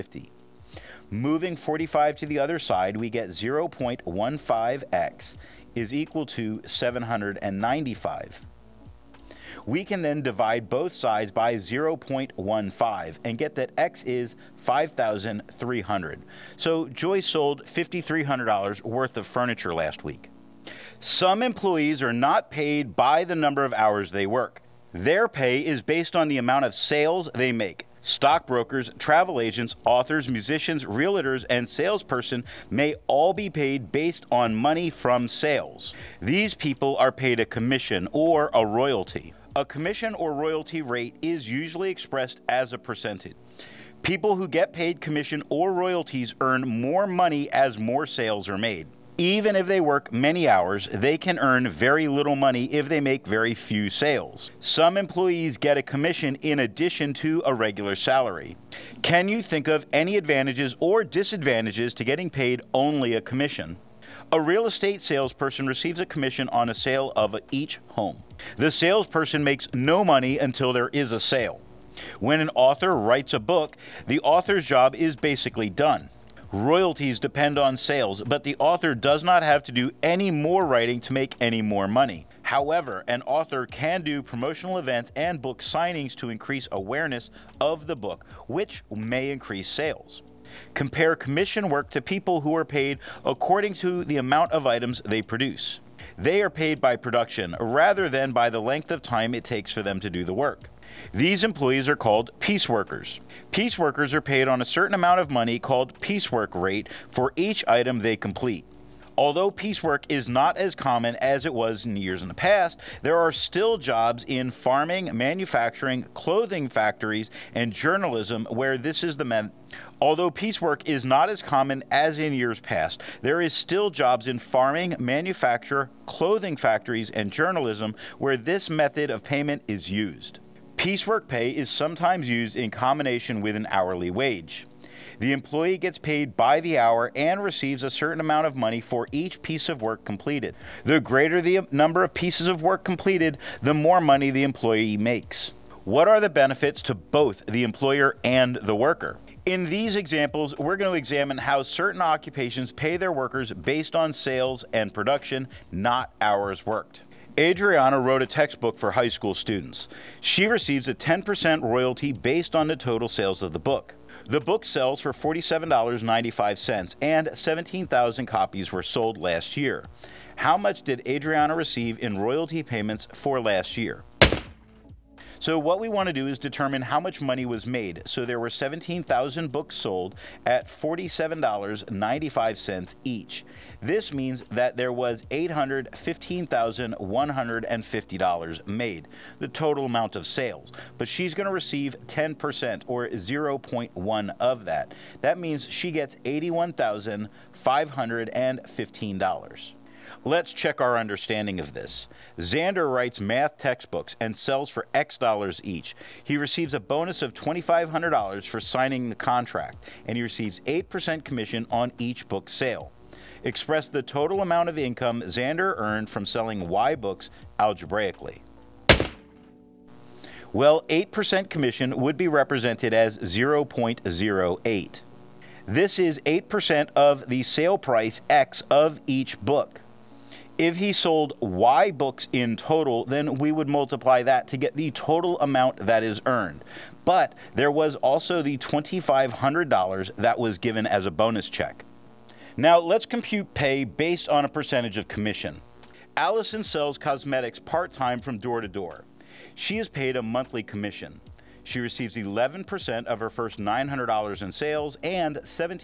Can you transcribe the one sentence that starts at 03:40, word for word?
Well, 8% commission would be represented as 0.08.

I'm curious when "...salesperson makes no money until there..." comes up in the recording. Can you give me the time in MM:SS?
01:08.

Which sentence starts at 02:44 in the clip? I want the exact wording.
The book sells for $47.95, and 17,000 copies were sold last year.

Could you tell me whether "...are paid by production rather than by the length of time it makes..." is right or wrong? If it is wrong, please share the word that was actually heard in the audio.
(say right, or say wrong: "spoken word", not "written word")
wrong: "takes", not "makes".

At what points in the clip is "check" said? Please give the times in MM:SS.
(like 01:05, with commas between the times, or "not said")
03:20, 04:01.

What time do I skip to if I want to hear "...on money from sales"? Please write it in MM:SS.
00:34.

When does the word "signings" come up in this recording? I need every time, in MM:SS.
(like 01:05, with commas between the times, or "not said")
01:25, 03:28.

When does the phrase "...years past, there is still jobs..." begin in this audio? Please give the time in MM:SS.
02:02.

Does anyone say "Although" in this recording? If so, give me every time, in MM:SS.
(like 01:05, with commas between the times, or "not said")
01:49, 02:00.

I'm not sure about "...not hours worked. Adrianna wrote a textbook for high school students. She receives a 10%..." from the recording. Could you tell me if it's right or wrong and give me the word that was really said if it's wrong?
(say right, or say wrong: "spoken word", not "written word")
right.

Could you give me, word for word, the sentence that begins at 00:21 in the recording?
Some employees are not paid by the number of hours they work.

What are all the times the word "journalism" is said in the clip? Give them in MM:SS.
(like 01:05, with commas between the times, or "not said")
01:57, 02:07.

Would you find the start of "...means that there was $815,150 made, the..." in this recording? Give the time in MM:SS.
03:04.